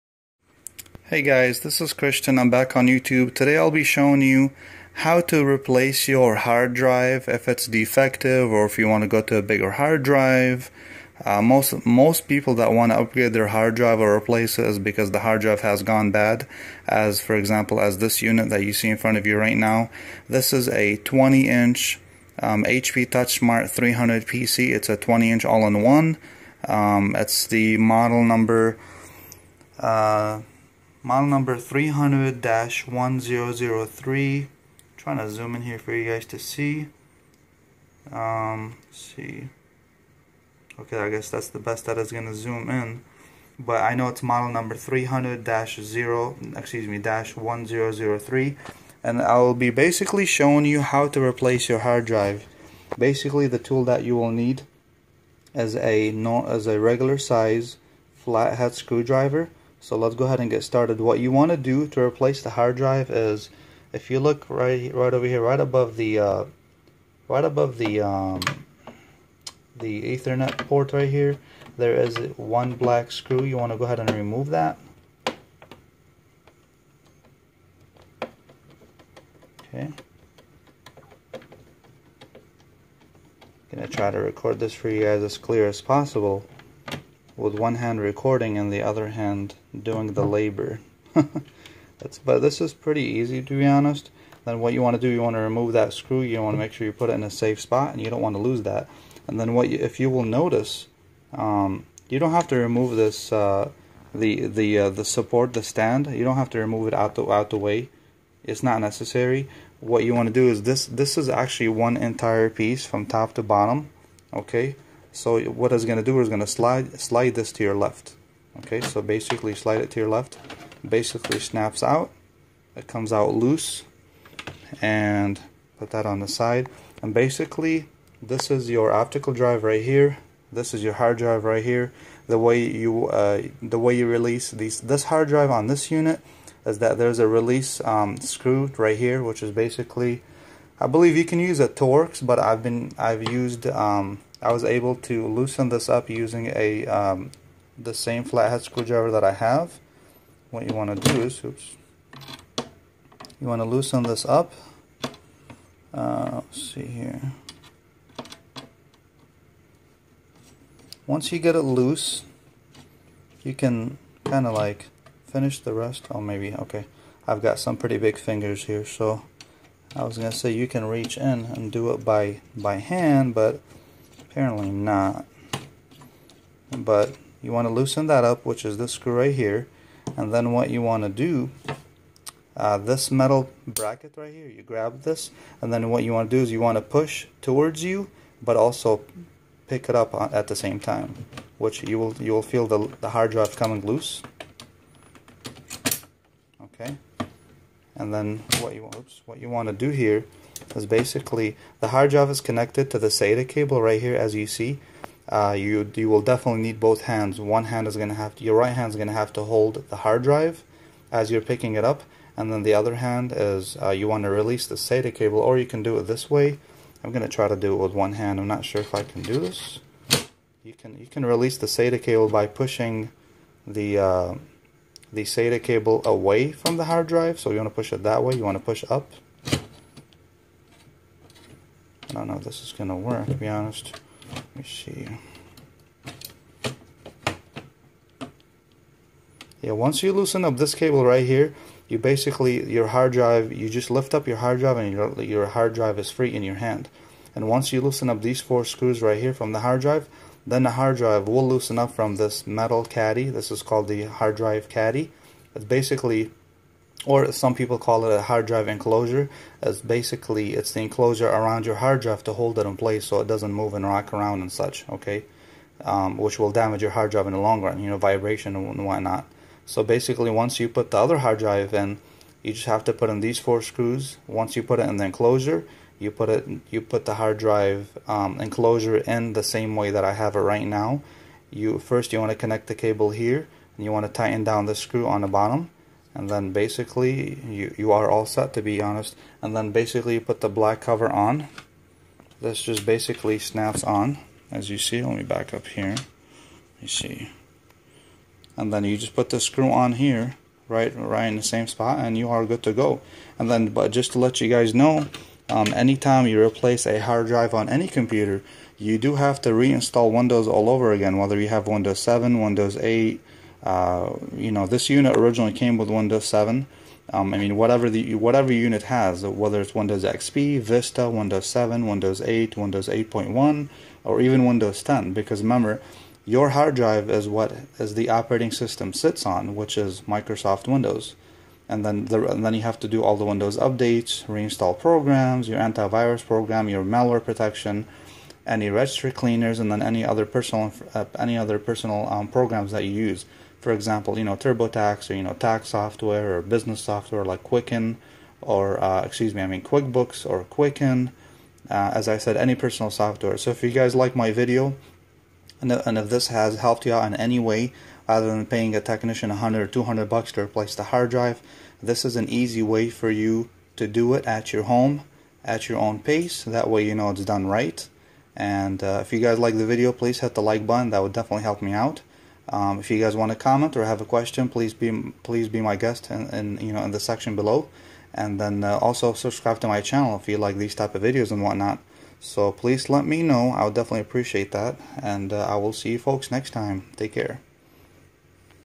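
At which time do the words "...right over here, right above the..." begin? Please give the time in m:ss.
1:04.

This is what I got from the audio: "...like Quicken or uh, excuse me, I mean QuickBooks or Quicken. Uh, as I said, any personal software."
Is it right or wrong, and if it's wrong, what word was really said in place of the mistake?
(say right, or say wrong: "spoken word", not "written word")
right.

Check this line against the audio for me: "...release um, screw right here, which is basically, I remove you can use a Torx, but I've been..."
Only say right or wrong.
wrong.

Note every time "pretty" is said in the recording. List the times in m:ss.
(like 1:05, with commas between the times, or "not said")
1:32, 2:47.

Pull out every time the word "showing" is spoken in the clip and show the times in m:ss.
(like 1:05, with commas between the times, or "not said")
0:03, 0:50.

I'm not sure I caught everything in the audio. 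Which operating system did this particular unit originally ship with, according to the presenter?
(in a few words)
Windows 7.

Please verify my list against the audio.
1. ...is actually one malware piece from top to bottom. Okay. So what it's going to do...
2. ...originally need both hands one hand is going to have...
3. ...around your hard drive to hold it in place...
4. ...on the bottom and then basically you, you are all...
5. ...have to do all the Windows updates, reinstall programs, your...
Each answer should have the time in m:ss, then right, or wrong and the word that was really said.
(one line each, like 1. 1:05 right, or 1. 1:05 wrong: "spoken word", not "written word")
1. 1:51 wrong: "entire", not "malware"
2. 3:26 wrong: "definitely", not "originally"
3. 4:21 right
4. 4:45 right
5. 5:32 right.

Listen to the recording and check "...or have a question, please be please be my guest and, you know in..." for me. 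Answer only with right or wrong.
right.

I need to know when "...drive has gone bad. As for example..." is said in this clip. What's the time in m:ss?
0:15.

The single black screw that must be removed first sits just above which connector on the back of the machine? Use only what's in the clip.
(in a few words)
Ethernet port.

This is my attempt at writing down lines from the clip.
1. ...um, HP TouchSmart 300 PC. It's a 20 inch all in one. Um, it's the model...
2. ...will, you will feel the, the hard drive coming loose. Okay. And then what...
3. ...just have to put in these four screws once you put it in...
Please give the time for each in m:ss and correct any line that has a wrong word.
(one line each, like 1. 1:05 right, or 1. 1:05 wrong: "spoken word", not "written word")
1. 0:22 right
2. 3:11 right
3. 4:32 right.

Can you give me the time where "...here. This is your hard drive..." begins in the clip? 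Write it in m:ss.
2:09.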